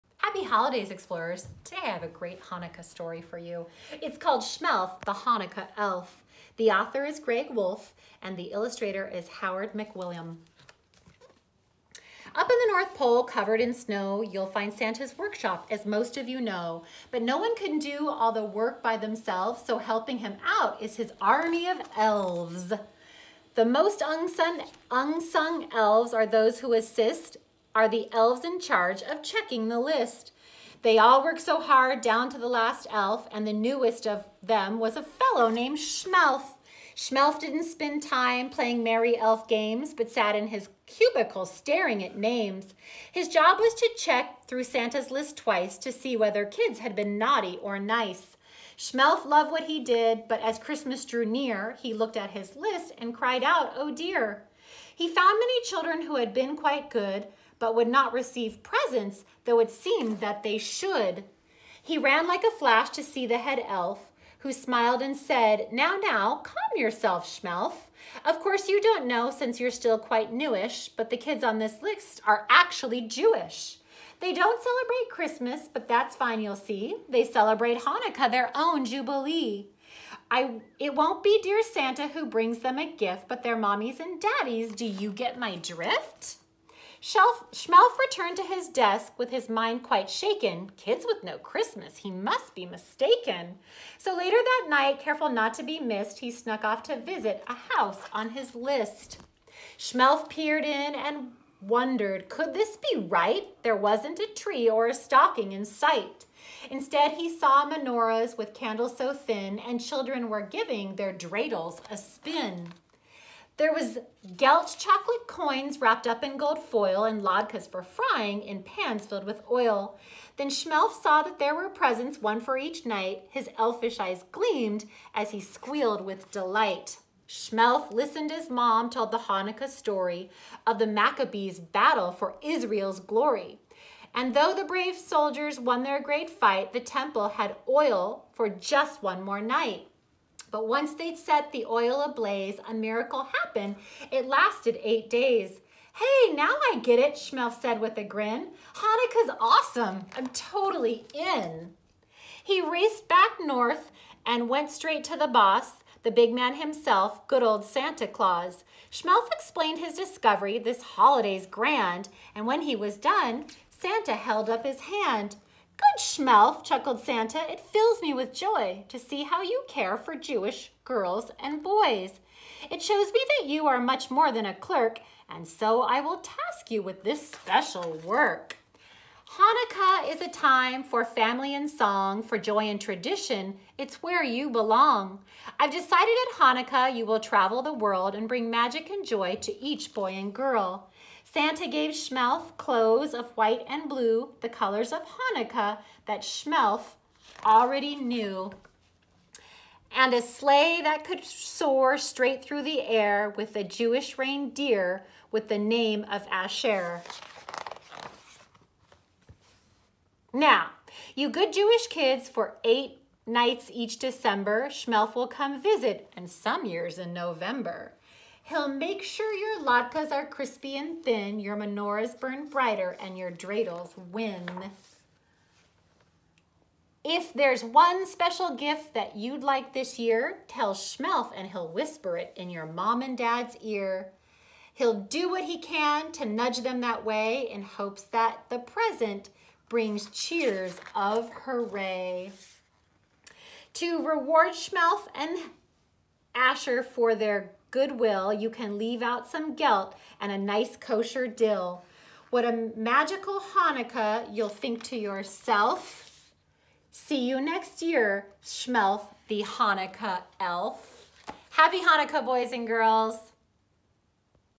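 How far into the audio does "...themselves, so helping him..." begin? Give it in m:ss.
0:18.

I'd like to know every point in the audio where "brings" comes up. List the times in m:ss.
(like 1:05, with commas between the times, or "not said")
1:22, 3:08, 3:59.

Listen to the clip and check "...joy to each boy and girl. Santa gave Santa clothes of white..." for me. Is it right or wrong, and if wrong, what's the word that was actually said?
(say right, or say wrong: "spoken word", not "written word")
wrong: "Shmelf", not "Santa".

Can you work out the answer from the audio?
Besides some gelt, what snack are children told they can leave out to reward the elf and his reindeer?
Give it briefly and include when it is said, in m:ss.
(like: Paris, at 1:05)
kosher dill, at 4:10.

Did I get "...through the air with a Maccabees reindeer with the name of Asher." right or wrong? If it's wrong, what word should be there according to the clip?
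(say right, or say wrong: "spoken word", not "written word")
wrong: "Jewish", not "Maccabees".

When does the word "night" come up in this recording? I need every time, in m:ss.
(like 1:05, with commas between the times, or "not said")
1:34, 2:02, 2:19, 3:33.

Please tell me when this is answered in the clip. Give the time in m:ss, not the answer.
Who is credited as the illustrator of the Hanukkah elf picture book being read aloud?
0:09.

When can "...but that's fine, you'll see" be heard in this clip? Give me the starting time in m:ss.
1:15.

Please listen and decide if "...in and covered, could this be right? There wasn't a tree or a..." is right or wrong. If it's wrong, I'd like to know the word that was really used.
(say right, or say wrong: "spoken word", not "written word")
wrong: "wondered", not "covered".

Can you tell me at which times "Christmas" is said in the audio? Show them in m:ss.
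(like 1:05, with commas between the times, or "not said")
0:50, 1:15, 1:31.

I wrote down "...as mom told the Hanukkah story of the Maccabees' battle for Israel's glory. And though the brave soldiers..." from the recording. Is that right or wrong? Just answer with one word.
right.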